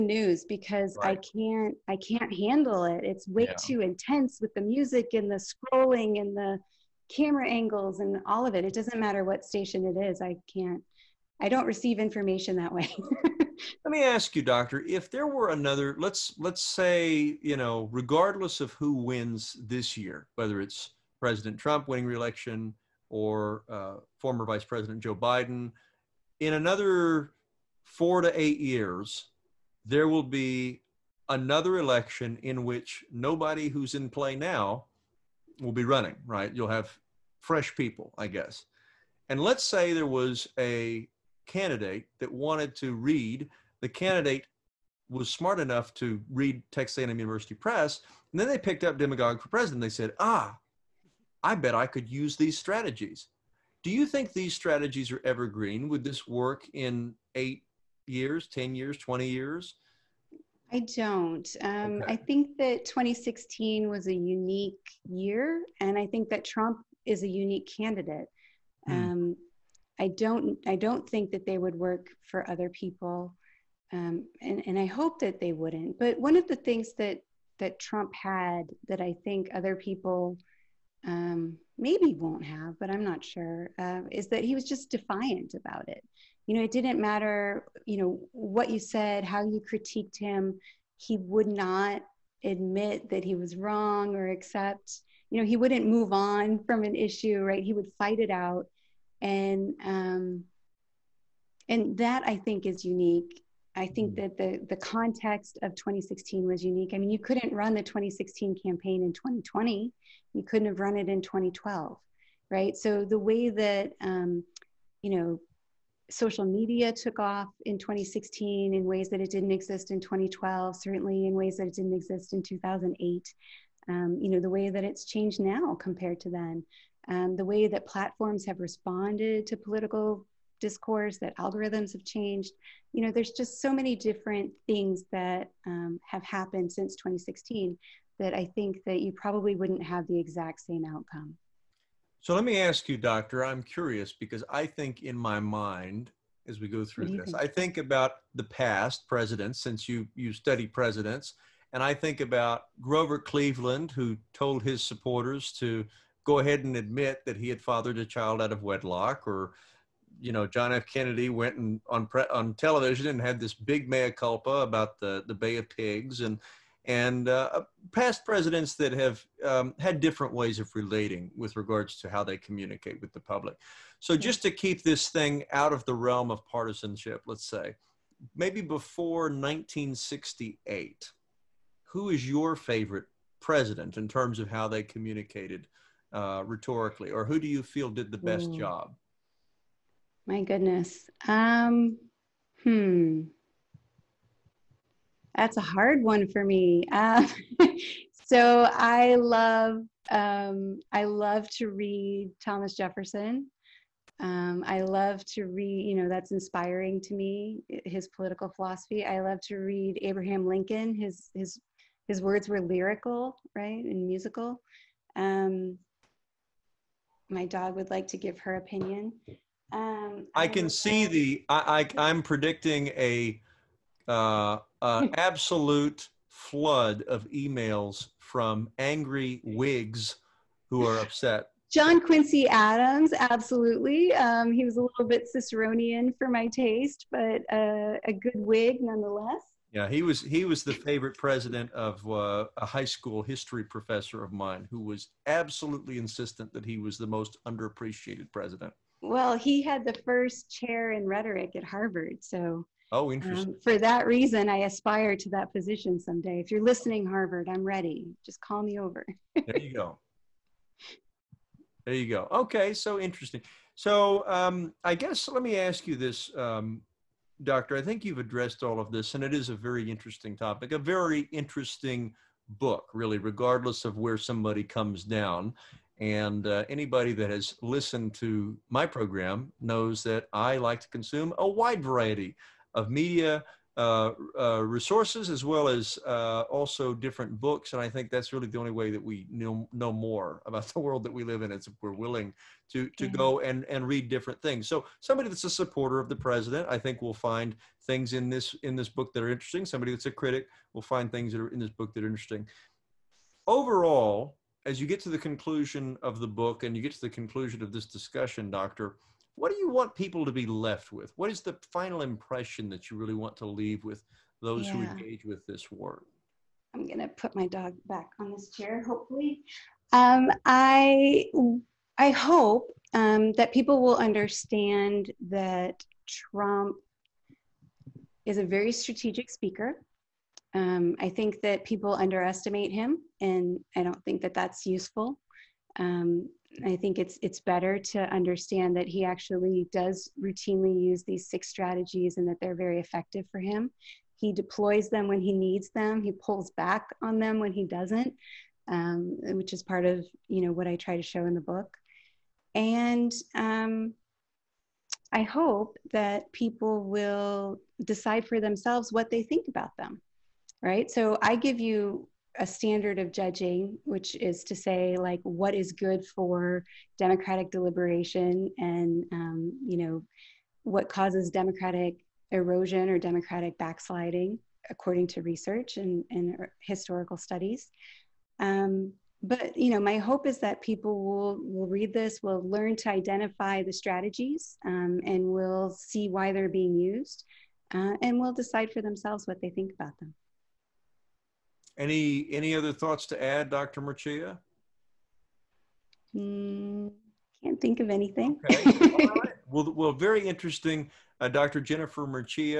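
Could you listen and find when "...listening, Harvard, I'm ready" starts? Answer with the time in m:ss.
4:16.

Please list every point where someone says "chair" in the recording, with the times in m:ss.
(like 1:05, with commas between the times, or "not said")
4:10, 5:18.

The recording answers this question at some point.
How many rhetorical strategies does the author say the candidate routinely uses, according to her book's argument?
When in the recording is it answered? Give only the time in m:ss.
5:41.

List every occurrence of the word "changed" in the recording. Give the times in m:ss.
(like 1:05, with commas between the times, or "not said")
2:05, 2:12.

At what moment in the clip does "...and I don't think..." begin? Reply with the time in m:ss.
5:33.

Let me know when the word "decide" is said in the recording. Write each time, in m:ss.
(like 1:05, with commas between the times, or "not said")
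5:57, 6:28.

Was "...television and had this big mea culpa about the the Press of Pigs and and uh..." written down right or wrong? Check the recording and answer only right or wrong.
wrong.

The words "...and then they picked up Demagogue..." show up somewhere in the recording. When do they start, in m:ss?
0:48.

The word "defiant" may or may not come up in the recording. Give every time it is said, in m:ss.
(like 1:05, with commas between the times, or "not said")
1:24.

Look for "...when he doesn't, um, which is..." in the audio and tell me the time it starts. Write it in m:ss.
5:47.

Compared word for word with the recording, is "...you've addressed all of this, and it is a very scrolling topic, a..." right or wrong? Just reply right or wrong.
wrong.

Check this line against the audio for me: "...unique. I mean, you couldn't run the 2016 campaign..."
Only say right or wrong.
right.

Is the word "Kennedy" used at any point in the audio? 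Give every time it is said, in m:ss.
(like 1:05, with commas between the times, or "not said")
2:40.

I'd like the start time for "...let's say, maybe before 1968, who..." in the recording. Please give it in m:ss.
2:57.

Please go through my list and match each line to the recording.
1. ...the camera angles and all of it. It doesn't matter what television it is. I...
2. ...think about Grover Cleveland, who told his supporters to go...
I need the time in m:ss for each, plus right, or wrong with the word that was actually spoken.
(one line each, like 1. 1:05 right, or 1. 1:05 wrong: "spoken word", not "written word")
1. 0:06 wrong: "station", not "television"
2. 2:31 right.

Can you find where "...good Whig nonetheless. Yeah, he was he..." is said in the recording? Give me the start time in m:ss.
3:58.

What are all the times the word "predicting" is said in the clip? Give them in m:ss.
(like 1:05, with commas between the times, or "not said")
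3:42.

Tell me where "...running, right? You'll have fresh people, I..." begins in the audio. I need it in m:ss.
0:35.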